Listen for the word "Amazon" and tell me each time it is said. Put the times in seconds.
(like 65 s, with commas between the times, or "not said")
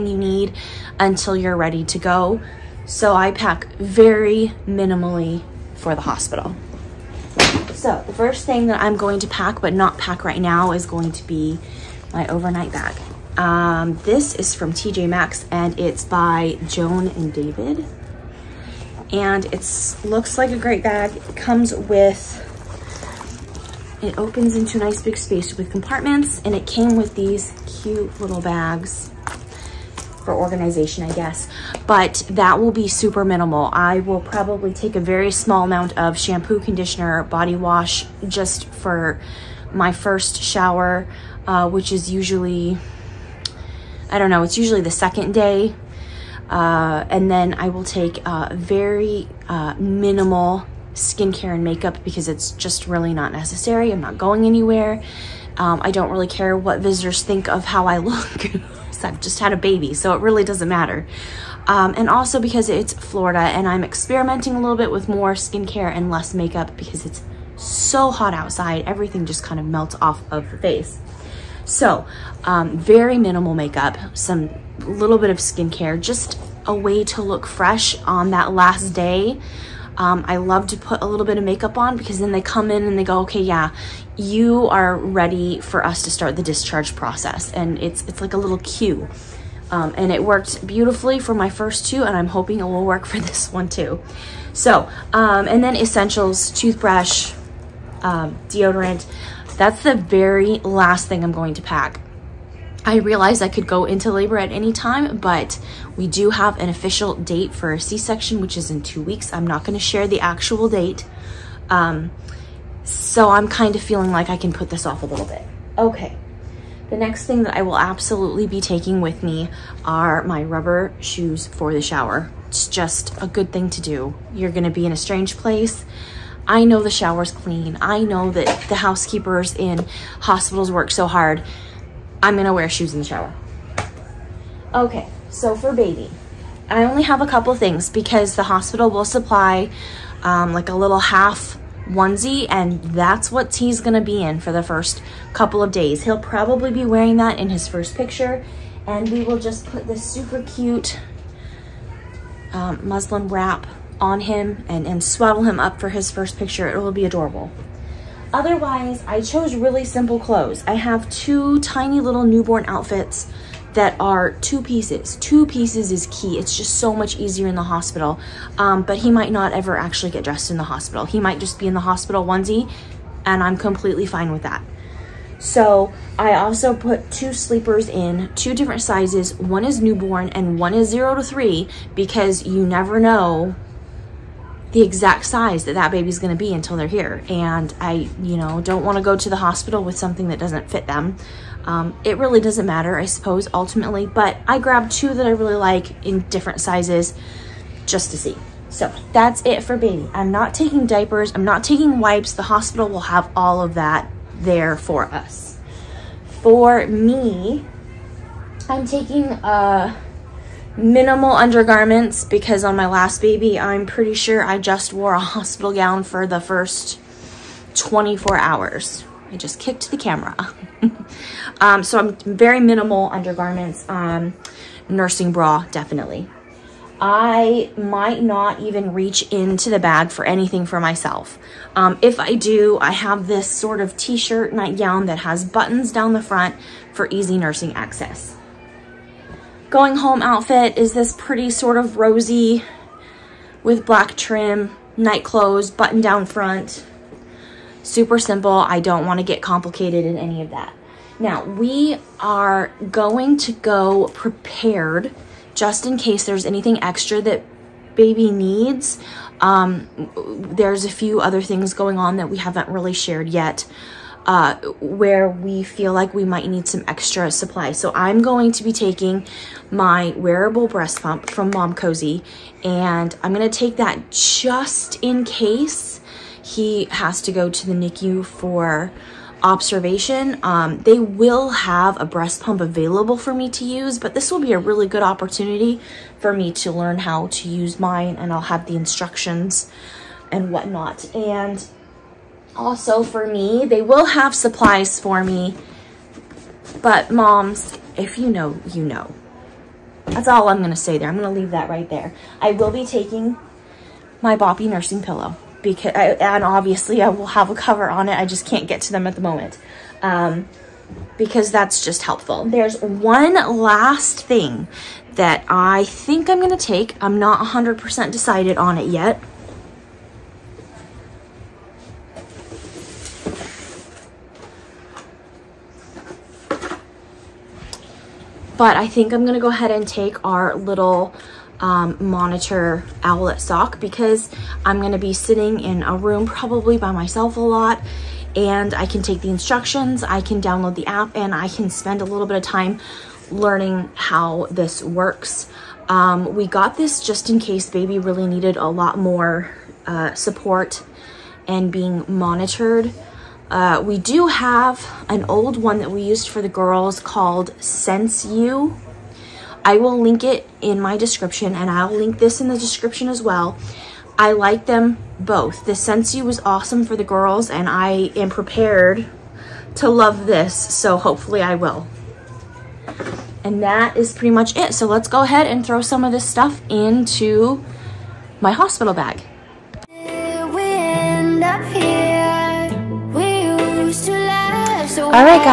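not said.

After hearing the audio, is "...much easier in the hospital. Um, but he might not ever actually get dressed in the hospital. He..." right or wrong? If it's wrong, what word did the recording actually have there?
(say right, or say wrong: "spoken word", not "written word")
right.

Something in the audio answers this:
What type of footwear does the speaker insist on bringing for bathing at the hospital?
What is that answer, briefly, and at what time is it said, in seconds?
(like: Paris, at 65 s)
rubber shoes, at 120 s.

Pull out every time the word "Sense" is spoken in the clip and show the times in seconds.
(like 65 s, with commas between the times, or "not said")
357 s, 365 s.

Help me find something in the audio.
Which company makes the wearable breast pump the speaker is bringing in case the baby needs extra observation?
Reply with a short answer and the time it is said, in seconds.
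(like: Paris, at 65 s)
Momcozy, at 271 s.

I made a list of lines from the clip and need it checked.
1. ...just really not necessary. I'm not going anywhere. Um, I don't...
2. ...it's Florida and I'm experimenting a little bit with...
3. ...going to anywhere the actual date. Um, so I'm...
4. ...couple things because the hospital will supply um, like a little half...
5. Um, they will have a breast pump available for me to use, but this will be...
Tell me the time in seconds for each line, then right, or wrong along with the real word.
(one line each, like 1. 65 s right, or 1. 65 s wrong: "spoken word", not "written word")
1. 52 s right
2. 62 s right
3. 109 s wrong: "share", not "anywhere"
4. 137 s right
5. 280 s right.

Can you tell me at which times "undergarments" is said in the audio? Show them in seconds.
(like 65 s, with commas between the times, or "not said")
211 s, 223 s.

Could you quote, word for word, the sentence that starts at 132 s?
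I'm gonna wear shoes in the shower.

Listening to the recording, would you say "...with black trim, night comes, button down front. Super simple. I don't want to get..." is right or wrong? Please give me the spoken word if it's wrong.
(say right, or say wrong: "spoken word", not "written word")
wrong: "clothes", not "comes".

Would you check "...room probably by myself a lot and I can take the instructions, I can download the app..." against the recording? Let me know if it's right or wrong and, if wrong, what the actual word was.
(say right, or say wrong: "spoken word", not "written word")
right.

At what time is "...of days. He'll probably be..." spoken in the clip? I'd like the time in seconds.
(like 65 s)
145 s.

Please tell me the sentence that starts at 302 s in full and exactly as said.
I will be taking my boppy nursing pillow because I, and obviously I will have a cover on it.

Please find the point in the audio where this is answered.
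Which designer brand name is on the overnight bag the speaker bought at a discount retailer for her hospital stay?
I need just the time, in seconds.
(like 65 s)
16 s.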